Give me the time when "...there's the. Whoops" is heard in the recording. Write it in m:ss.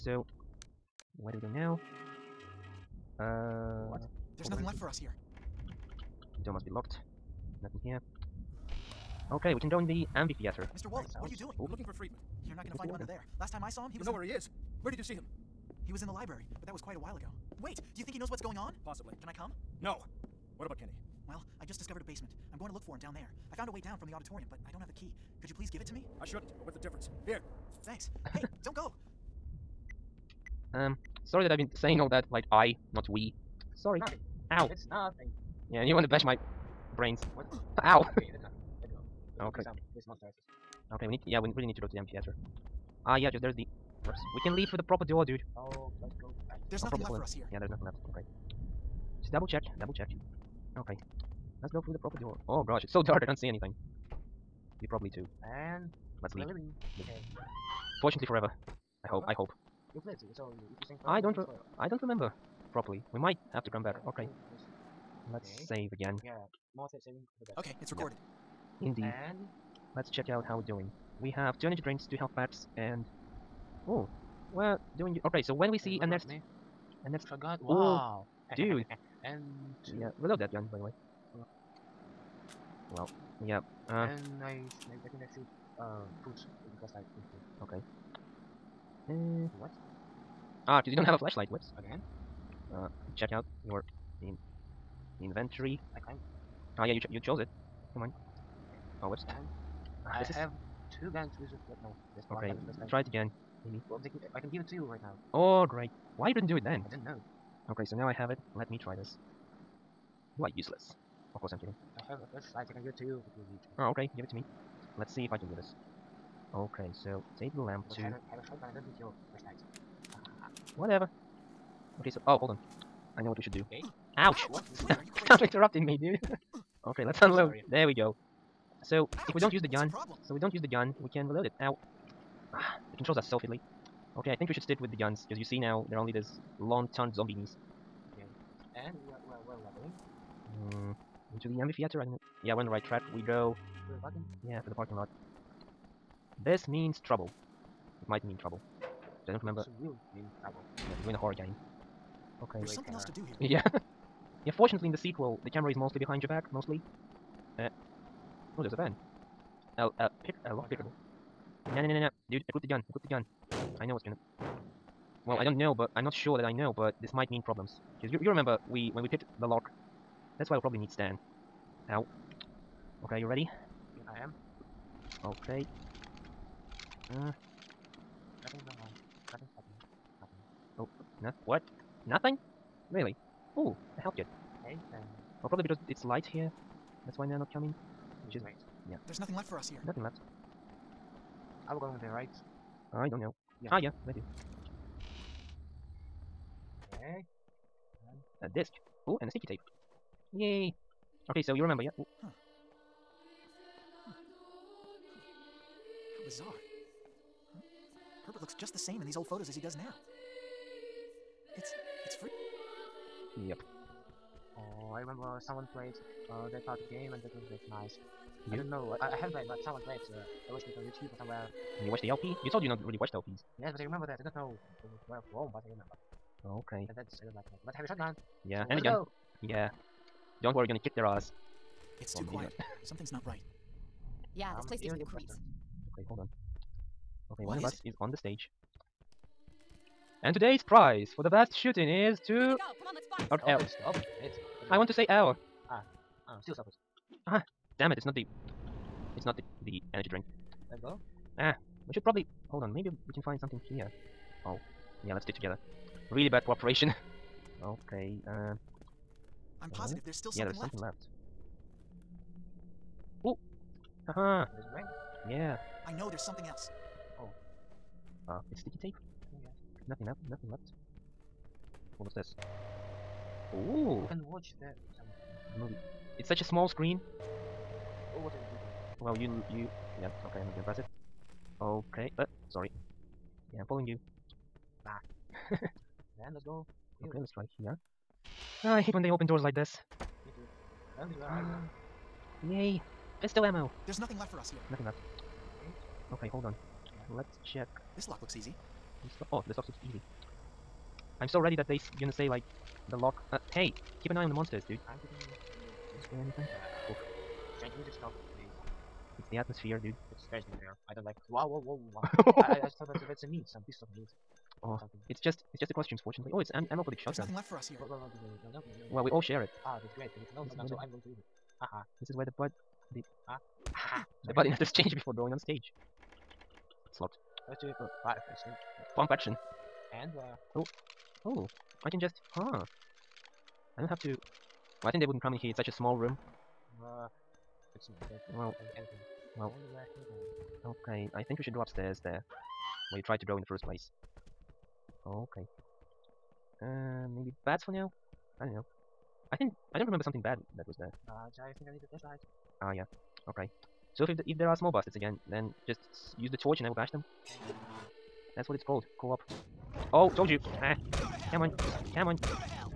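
0:43.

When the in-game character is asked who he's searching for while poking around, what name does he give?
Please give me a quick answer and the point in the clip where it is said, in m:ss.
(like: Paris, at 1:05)
Friedman, at 0:11.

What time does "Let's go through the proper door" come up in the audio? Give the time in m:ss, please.
0:51.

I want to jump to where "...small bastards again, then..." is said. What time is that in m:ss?
5:54.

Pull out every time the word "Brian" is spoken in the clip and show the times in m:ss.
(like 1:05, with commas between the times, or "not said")
not said.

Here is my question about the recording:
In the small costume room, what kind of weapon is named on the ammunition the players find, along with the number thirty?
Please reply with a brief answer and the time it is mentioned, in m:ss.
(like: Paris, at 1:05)
Pump action, at 5:28.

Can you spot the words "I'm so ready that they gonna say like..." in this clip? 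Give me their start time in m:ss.
5:01.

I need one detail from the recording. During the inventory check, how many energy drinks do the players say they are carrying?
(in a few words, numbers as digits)
2.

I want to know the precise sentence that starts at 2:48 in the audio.
Because you, you remember we when we picked the lock.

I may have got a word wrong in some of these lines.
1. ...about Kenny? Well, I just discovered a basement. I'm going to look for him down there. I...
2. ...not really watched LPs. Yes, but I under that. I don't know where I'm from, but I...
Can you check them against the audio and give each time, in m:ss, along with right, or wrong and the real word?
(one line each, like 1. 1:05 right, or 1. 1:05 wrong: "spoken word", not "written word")
1. 0:20 right
2. 3:42 wrong: "remember", not "under".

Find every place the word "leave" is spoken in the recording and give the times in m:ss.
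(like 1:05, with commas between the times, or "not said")
0:44, 0:56.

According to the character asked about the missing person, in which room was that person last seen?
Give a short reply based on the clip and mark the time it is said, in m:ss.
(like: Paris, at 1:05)
the library, at 0:15.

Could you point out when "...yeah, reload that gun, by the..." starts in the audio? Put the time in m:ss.
1:19.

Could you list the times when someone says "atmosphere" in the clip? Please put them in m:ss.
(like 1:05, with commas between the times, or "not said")
5:09.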